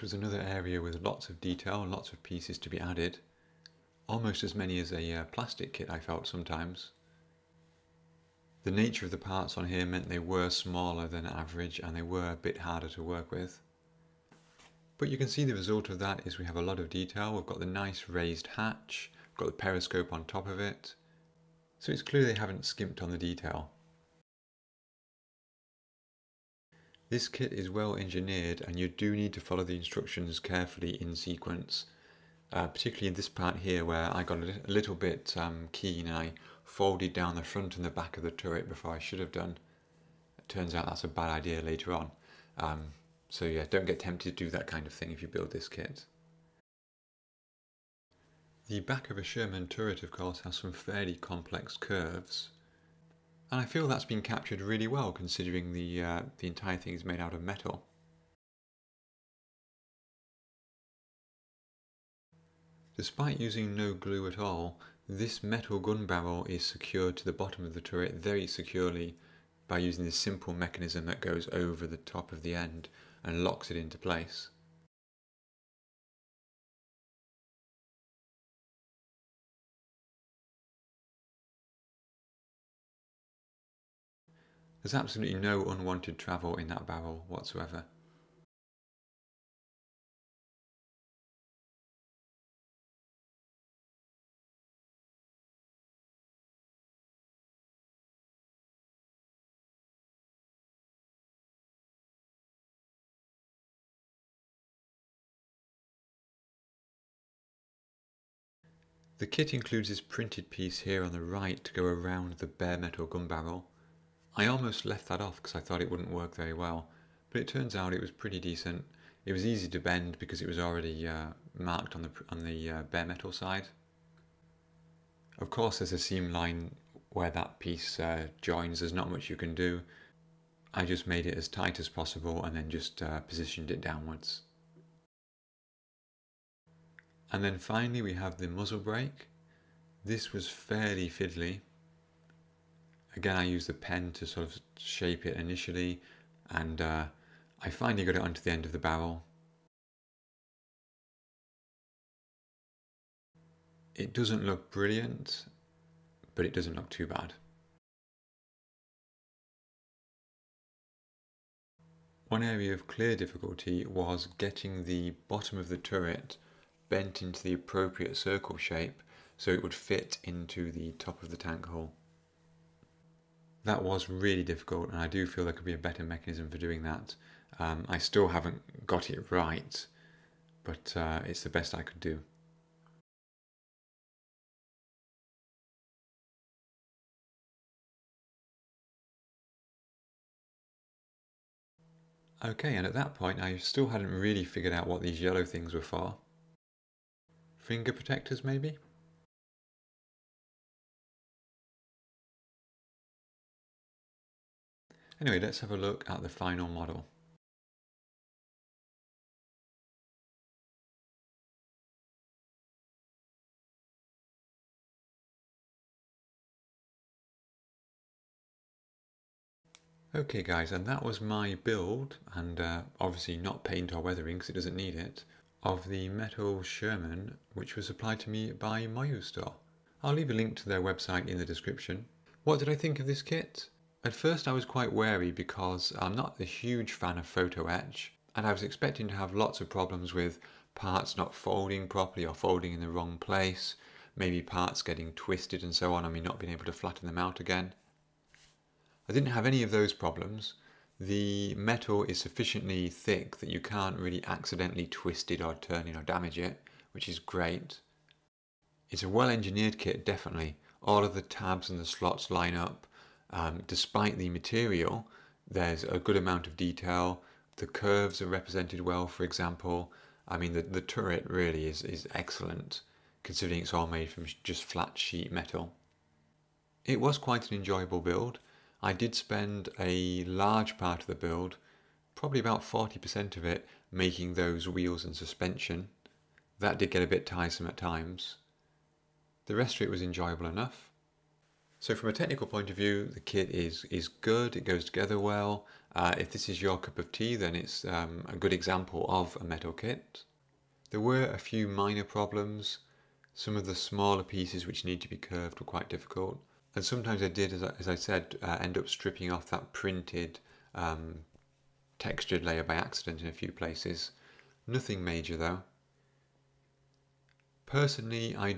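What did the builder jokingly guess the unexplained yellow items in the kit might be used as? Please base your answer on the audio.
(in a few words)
Finger protectors.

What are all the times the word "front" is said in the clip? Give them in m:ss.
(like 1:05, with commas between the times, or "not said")
0:37.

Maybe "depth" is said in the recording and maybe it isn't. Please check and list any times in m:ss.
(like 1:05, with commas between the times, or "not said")
not said.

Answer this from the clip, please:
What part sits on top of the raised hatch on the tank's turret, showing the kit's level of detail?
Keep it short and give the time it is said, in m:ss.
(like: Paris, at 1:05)
Periscope, at 0:19.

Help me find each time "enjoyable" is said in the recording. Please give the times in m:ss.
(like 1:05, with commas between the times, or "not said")
4:37, 4:50.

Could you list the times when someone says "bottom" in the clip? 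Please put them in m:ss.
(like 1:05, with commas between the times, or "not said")
1:07, 2:45.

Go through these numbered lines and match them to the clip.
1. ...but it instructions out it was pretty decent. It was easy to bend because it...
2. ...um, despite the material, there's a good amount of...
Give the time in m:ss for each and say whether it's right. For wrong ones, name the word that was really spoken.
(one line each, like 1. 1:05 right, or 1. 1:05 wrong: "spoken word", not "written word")
1. 1:57 wrong: "turns", not "instructions"
2. 4:23 right.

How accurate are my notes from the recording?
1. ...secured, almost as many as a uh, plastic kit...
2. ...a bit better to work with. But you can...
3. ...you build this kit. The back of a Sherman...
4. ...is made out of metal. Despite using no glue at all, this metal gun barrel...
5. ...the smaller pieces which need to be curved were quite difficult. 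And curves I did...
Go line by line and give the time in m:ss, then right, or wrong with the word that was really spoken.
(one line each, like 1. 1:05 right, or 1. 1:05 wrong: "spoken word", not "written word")
1. 0:02 wrong: "added", not "secured"
2. 0:12 wrong: "harder", not "better"
3. 0:45 right
4. 0:56 right
5. 5:03 wrong: "sometimes", not "curves".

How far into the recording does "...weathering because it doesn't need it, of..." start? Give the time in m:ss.
3:43.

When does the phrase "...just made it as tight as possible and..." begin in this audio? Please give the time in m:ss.
2:10.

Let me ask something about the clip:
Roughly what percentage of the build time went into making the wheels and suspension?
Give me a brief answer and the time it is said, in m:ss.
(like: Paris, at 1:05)
40%, at 4:42.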